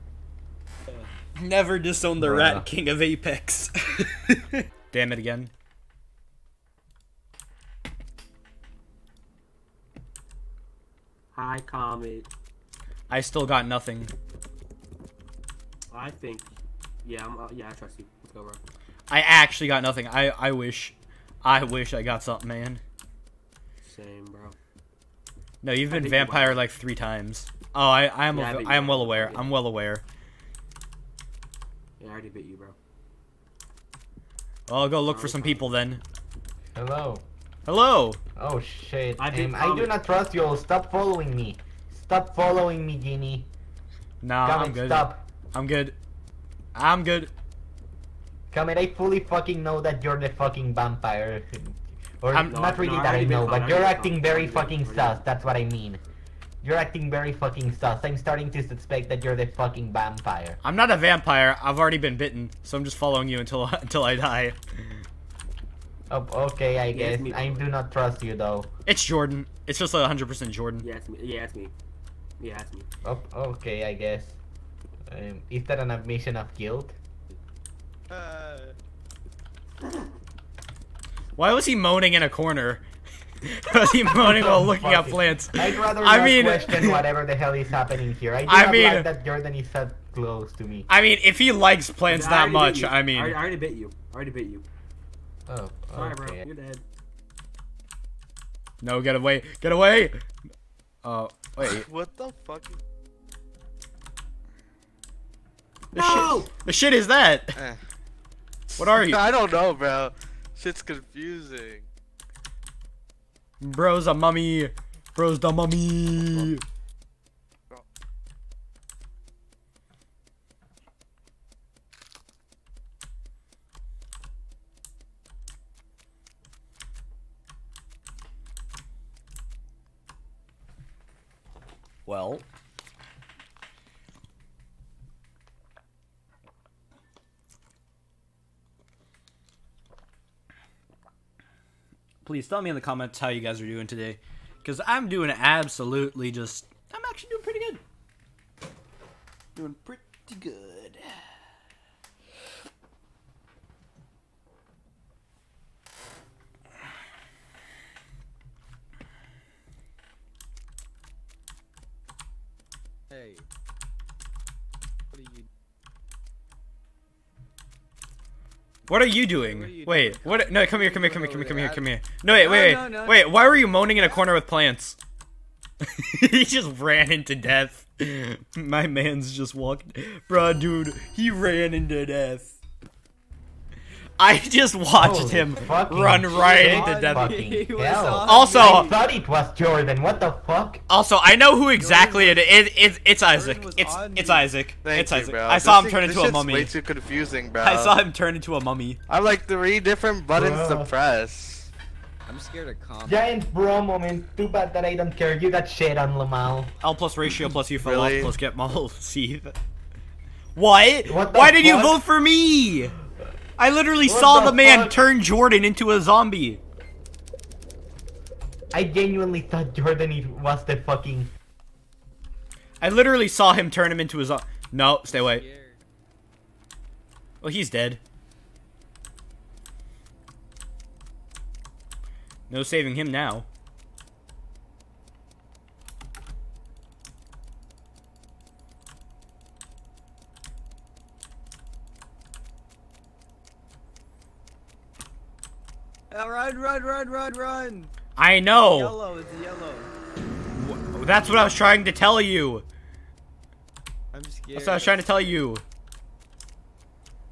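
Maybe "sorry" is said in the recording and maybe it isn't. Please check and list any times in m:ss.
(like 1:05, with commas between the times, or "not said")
1:35.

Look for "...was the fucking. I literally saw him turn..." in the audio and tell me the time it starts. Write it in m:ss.
3:40.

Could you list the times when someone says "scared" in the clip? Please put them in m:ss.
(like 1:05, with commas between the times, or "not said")
3:22, 4:14.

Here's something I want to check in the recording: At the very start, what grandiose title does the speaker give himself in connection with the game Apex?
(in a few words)
Rat King of Apex.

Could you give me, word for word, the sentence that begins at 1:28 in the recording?
I, I mean, like that Jordan is that close to me.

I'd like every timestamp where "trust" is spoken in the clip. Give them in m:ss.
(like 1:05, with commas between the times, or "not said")
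0:17, 0:40, 1:07.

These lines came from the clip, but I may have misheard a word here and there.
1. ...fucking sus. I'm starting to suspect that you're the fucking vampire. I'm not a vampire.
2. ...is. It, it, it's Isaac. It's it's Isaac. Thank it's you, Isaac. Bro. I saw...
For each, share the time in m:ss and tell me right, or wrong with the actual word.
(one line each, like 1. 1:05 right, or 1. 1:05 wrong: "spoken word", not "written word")
1. 0:57 right
2. 3:12 right.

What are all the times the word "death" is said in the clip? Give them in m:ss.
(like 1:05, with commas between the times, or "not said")
2:57, 3:02, 3:07.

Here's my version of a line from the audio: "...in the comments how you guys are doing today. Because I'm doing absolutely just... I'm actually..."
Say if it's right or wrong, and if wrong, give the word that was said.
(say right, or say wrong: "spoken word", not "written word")
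right.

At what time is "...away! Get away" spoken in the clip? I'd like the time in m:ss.
1:39.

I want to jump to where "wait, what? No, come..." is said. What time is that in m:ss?
2:49.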